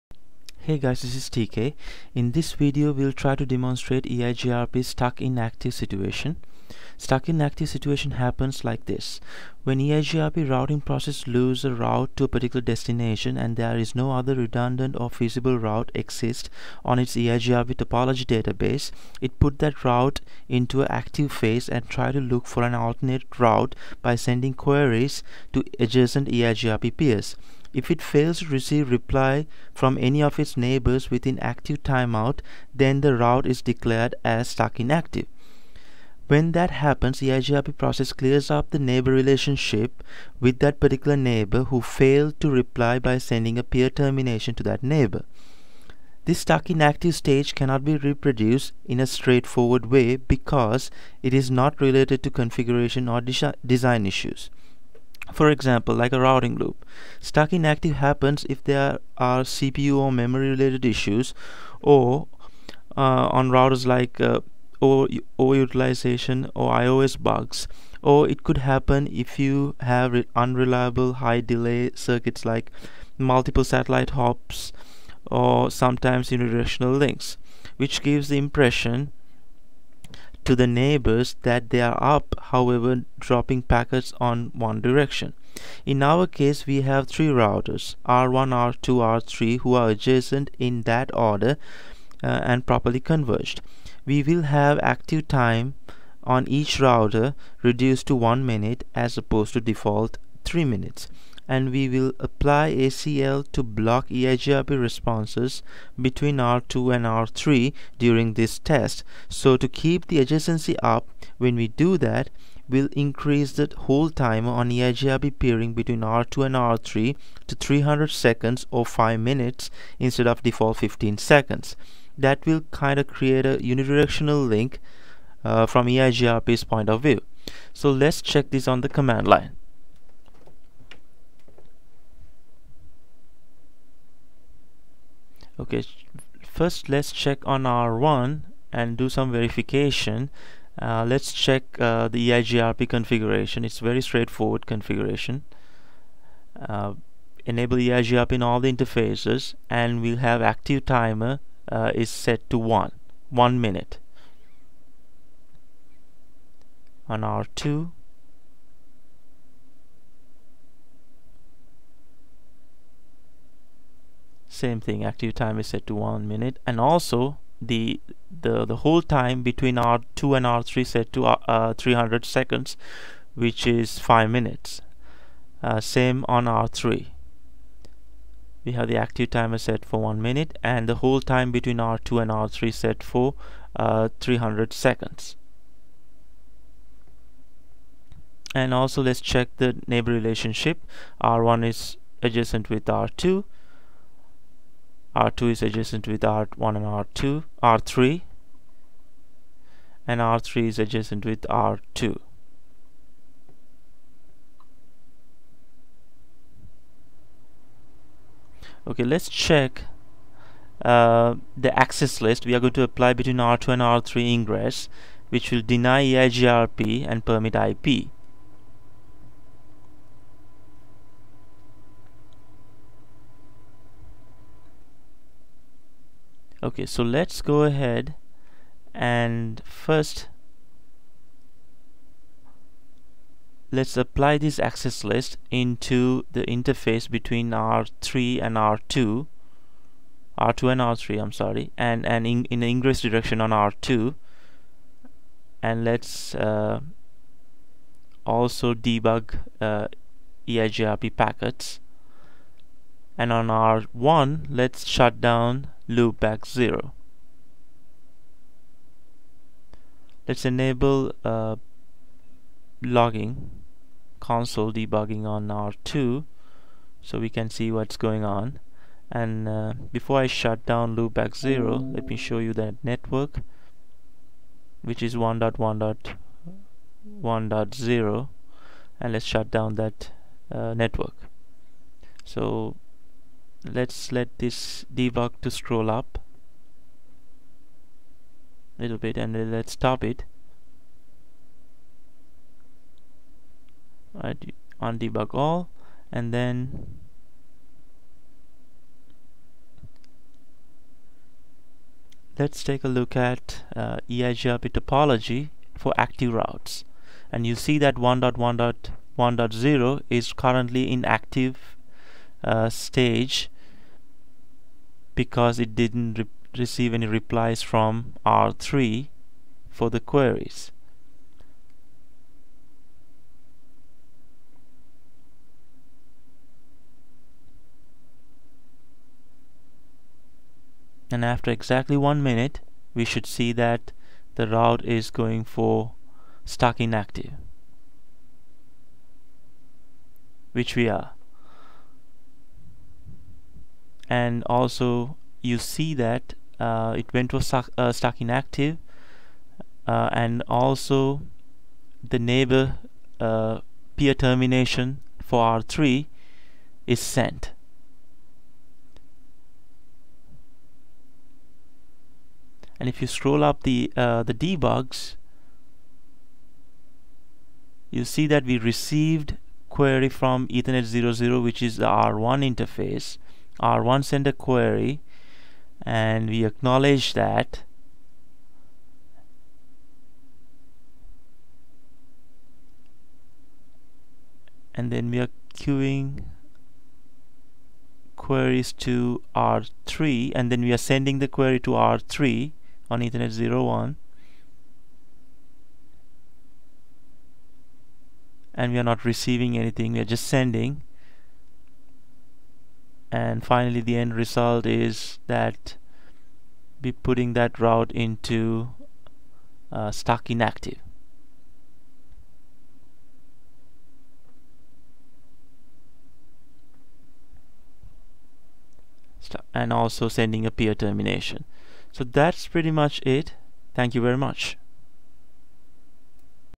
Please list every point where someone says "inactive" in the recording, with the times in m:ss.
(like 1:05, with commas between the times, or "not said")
5:10, 6:50.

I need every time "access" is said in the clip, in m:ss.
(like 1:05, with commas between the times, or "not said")
3:31, 3:54.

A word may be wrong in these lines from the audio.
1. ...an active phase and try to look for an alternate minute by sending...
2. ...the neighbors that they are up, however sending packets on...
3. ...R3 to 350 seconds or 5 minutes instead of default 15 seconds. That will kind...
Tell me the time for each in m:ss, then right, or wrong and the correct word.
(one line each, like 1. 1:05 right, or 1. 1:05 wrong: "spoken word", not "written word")
1. 0:20 wrong: "route", not "minute"
2. 1:20 wrong: "dropping", not "sending"
3. 1:56 wrong: "300", not "350".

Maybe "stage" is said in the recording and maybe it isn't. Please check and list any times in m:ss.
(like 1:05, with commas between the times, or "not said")
0:47, 5:12.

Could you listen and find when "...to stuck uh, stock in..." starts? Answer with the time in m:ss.
5:47.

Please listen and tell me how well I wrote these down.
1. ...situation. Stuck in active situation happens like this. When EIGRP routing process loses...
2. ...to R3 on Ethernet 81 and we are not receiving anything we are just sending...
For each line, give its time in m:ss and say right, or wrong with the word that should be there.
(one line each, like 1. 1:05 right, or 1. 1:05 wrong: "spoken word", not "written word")
1. 0:05 right
2. 6:31 wrong: "01", not "81".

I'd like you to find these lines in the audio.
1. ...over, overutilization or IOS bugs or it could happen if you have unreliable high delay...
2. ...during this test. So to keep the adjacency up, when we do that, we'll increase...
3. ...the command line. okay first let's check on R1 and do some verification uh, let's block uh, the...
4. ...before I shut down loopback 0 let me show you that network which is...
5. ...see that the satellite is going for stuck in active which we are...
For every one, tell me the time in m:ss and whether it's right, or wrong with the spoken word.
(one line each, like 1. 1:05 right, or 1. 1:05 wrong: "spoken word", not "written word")
1. 1:04 right
2. 1:47 right
3. 2:08 wrong: "check", not "block"
4. 4:29 right
5. 5:33 wrong: "route", not "satellite".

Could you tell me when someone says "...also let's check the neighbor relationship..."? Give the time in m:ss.
3:08.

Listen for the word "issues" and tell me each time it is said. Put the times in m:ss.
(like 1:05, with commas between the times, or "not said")
0:54, 1:00.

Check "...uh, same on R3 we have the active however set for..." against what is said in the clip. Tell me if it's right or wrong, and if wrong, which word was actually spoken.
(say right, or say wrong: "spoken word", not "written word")
wrong: "timer", not "however".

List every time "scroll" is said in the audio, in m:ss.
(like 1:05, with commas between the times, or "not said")
4:45, 6:03.